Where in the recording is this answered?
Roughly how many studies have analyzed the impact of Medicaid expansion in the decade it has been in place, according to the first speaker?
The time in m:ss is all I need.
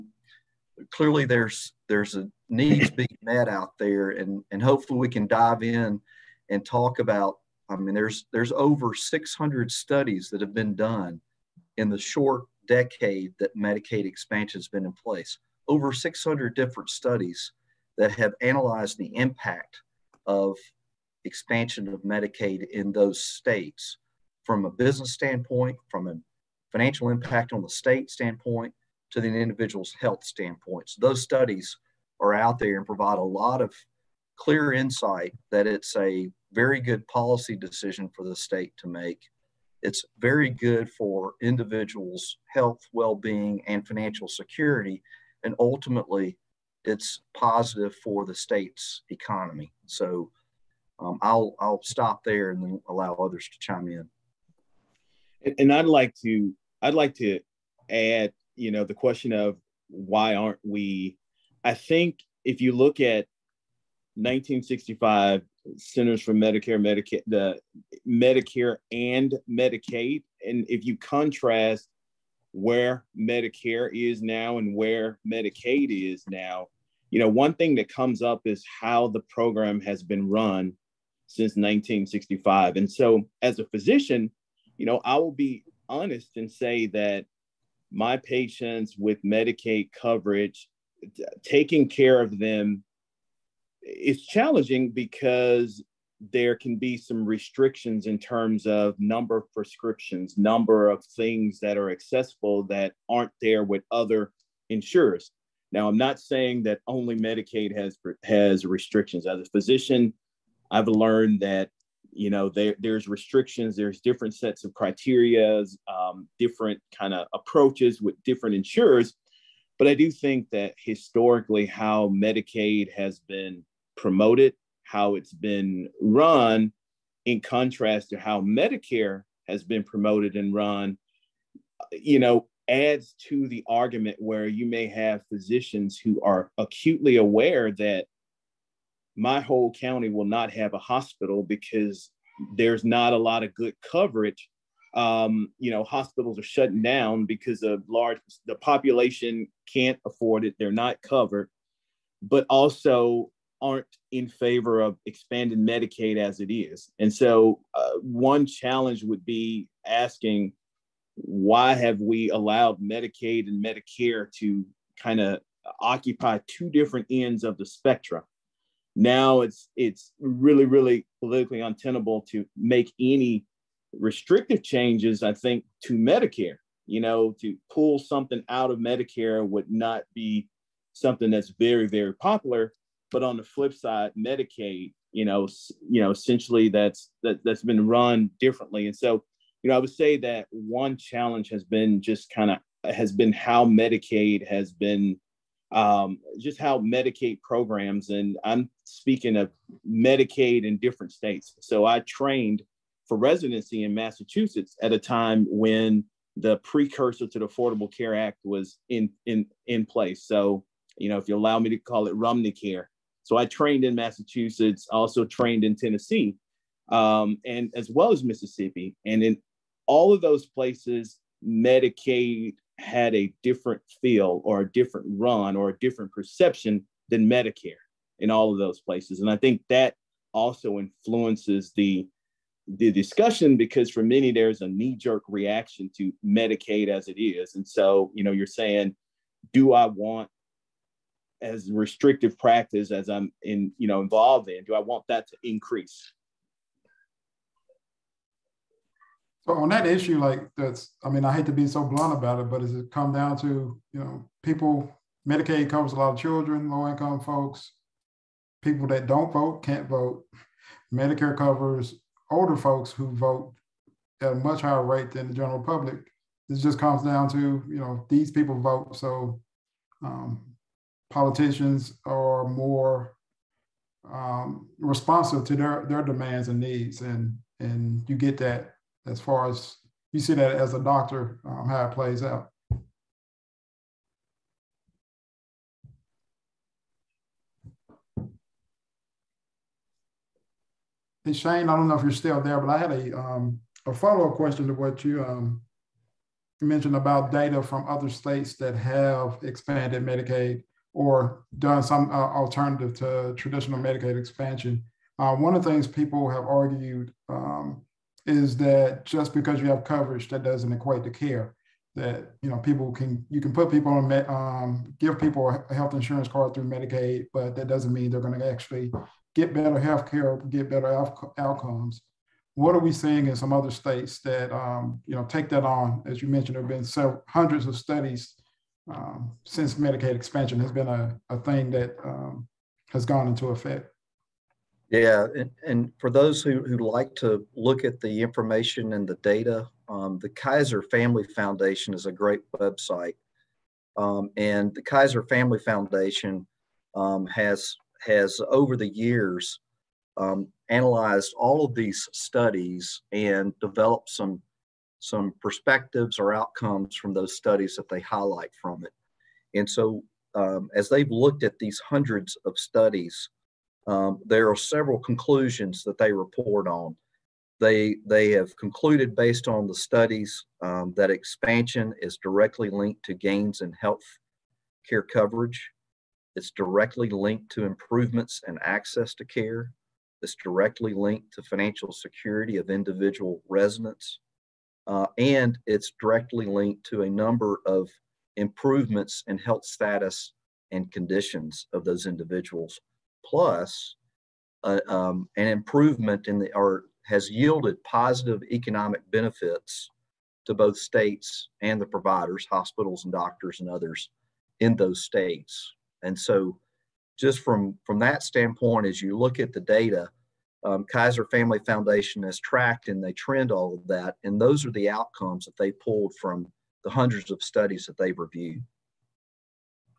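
0:08.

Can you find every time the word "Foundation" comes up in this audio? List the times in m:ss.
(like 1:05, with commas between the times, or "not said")
5:41, 5:45, 6:51.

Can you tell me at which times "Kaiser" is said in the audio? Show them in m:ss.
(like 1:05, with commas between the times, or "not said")
5:40, 5:44, 6:50.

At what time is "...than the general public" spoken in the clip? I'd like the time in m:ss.
4:25.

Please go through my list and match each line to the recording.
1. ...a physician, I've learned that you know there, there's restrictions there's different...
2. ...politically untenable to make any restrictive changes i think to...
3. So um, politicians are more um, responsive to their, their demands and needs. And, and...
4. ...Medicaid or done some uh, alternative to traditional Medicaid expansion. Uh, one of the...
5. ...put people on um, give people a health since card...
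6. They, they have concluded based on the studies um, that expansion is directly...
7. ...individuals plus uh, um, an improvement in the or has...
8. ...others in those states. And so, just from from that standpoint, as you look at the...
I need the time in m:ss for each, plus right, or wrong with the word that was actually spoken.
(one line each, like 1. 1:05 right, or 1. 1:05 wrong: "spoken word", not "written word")
1. 1:49 right
2. 2:51 right
3. 4:28 right
4. 5:00 right
5. 5:13 wrong: "insurance", not "since"
6. 6:07 right
7. 6:32 right
8. 6:43 right.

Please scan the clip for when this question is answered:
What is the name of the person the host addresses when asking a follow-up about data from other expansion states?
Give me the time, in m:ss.
4:51.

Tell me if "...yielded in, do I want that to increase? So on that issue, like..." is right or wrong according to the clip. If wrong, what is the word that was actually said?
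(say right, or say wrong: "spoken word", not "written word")
wrong: "involved", not "yielded".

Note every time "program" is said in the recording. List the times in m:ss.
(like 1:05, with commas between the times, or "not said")
1:19, 3:17.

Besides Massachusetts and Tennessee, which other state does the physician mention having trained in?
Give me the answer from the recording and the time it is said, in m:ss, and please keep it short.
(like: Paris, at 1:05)
Mississippi, at 3:38.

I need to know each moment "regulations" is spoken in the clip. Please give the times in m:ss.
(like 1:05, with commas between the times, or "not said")
not said.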